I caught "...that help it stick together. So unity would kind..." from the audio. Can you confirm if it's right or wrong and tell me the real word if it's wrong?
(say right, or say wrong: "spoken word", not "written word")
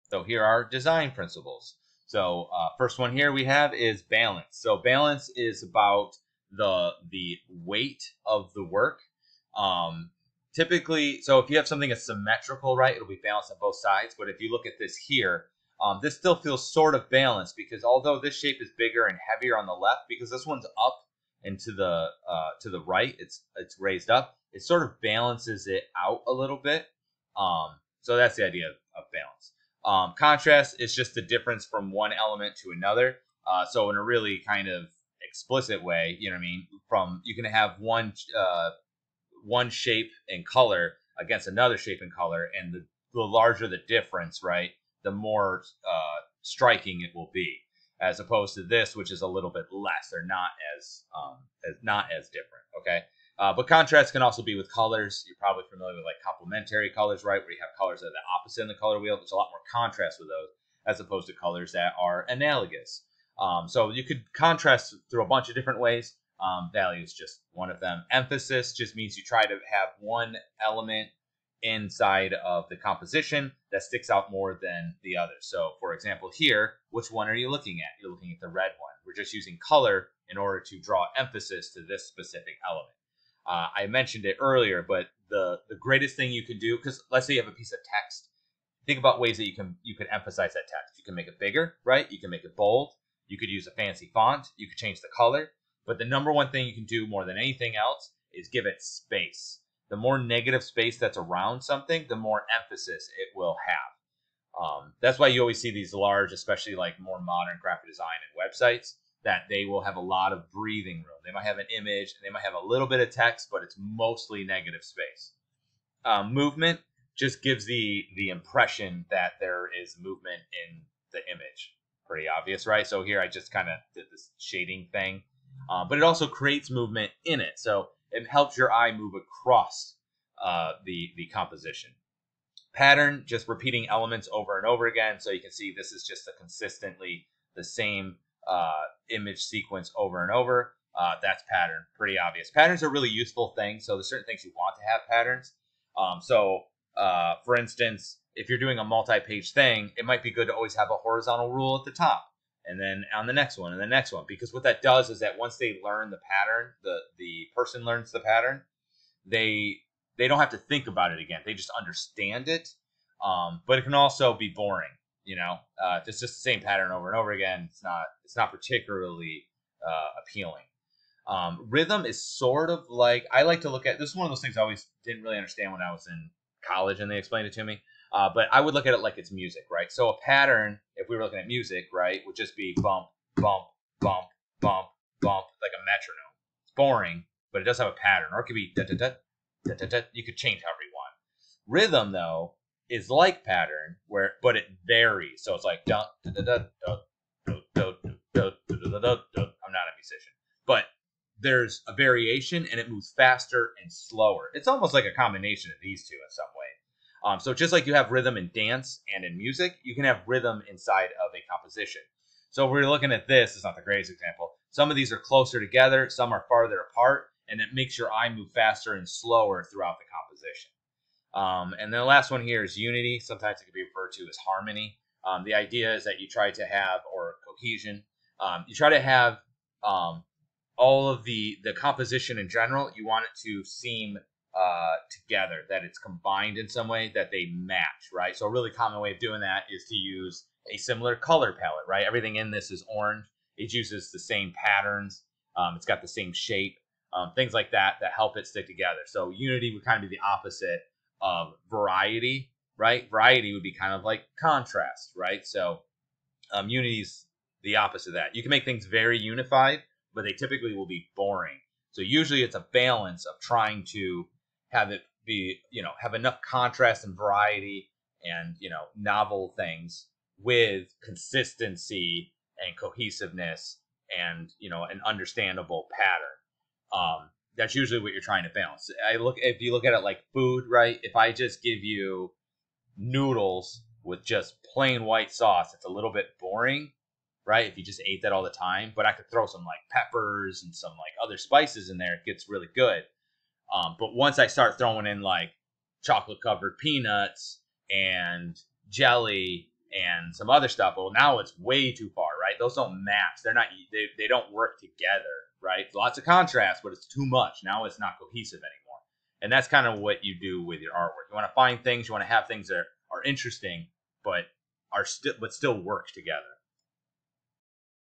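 right.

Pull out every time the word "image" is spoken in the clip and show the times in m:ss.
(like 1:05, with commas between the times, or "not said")
1:51, 2:01, 2:19.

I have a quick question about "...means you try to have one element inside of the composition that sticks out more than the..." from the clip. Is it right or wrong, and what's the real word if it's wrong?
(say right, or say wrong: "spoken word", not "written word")
right.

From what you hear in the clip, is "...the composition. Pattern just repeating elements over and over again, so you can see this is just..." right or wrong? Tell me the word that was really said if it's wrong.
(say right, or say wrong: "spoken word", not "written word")
right.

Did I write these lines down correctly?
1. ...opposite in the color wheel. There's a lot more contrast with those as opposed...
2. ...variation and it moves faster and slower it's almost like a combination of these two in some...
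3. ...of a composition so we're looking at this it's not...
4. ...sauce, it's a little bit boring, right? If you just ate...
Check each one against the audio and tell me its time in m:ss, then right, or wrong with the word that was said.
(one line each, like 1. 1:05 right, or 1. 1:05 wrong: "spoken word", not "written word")
1. 0:58 right
2. 3:21 right
3. 3:31 right
4. 4:45 right.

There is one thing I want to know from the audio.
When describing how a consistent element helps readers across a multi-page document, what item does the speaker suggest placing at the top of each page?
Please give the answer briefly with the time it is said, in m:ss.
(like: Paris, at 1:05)
A horizontal rule, at 2:30.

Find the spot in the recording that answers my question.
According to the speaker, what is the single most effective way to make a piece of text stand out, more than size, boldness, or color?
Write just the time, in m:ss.
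1:38.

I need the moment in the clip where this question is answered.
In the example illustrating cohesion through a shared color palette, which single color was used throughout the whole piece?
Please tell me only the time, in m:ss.
4:02.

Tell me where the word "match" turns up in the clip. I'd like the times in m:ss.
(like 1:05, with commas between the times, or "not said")
3:57, 5:03.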